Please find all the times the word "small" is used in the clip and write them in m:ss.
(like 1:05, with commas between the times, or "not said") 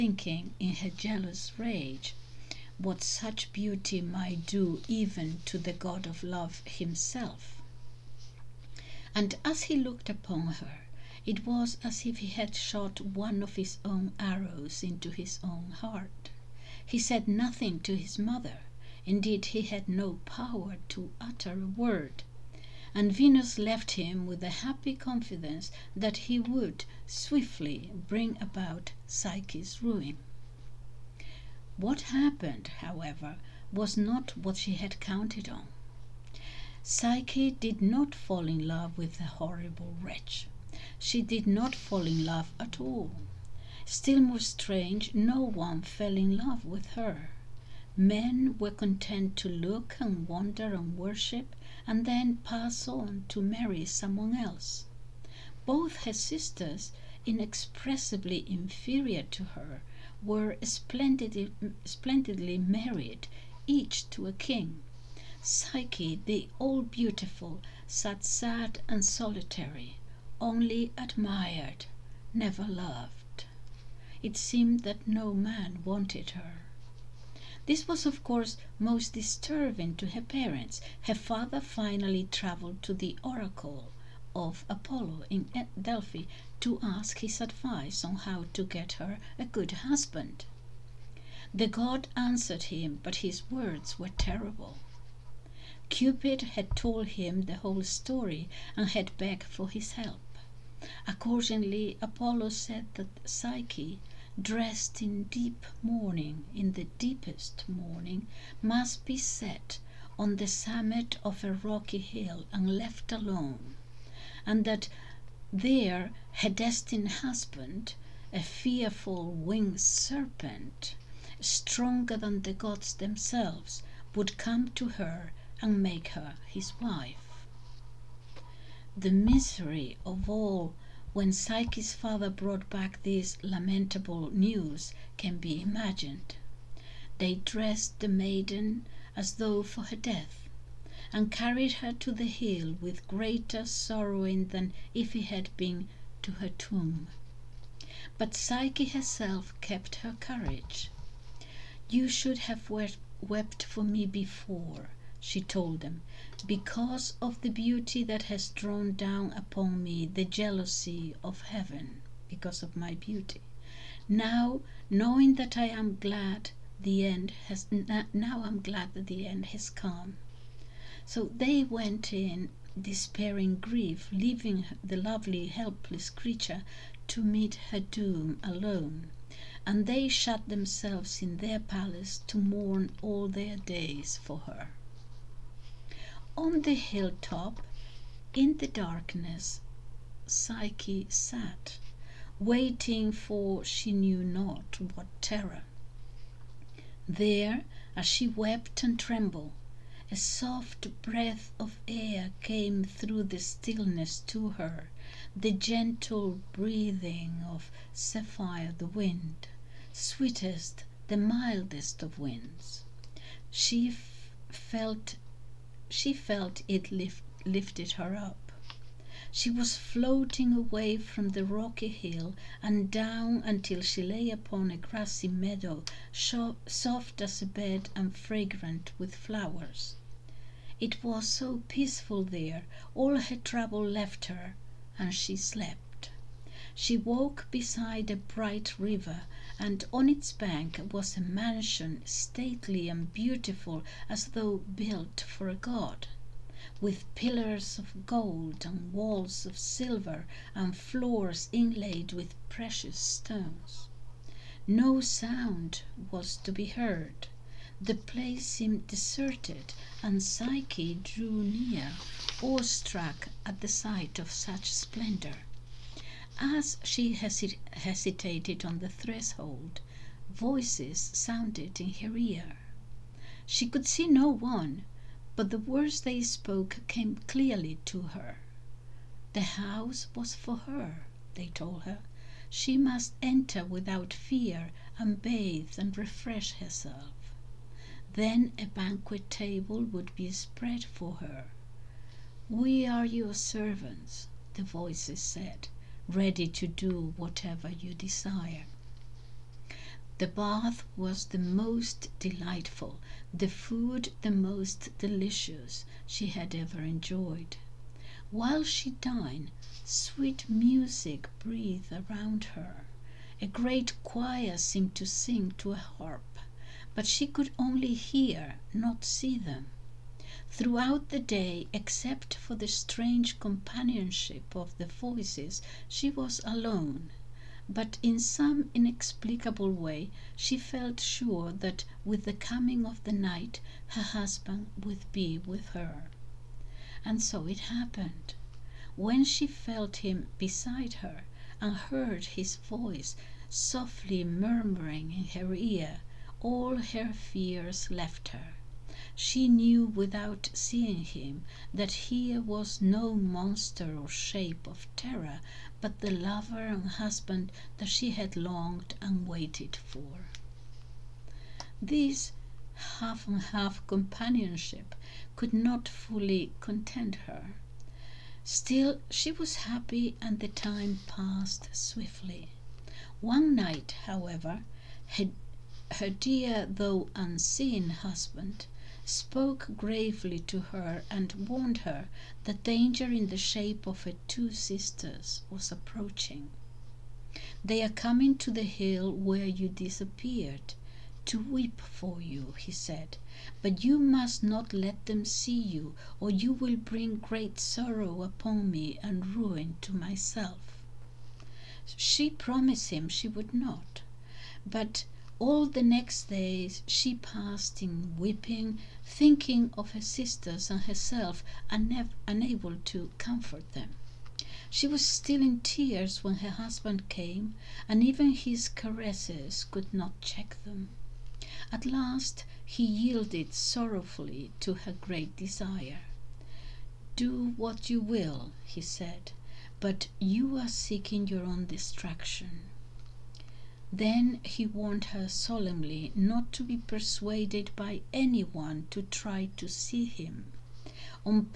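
not said.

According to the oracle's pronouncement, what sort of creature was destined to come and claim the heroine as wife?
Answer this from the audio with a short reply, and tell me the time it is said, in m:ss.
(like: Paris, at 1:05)
winged serpent, at 1:59.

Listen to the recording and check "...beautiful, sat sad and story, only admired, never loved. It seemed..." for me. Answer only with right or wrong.
wrong.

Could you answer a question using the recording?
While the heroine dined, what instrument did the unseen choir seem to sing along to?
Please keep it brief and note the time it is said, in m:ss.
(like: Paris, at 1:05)
harp, at 5:15.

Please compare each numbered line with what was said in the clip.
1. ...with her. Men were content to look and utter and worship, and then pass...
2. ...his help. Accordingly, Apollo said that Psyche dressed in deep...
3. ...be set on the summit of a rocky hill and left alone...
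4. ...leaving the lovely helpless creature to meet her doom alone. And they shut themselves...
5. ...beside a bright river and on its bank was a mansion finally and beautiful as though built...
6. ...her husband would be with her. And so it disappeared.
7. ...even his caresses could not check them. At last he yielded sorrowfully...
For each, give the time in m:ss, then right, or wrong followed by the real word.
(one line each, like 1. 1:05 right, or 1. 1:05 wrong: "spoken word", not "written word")
1. 0:46 wrong: "wonder", not "utter"
2. 1:39 right
3. 1:49 right
4. 2:54 right
5. 3:57 wrong: "stately", not "finally"
6. 5:33 wrong: "happened", not "disappeared"
7. 6:58 right.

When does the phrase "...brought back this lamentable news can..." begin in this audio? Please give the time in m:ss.
2:12.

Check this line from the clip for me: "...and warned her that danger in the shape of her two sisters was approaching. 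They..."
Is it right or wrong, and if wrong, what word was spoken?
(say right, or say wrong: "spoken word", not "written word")
right.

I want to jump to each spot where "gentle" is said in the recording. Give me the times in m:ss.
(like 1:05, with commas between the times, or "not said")
3:25.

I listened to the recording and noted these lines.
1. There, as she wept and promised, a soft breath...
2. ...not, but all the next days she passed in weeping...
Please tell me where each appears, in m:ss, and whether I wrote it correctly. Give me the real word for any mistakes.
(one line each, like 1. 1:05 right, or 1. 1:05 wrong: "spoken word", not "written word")
1. 3:17 wrong: "trembled", not "promised"
2. 6:43 right.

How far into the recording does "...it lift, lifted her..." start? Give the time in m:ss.
3:36.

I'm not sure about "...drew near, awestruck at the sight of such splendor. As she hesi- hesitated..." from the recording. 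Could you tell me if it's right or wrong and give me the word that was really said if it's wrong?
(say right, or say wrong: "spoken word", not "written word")
right.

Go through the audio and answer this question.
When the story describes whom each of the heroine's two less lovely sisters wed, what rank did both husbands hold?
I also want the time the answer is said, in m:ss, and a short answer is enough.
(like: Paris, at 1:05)
king, at 1:03.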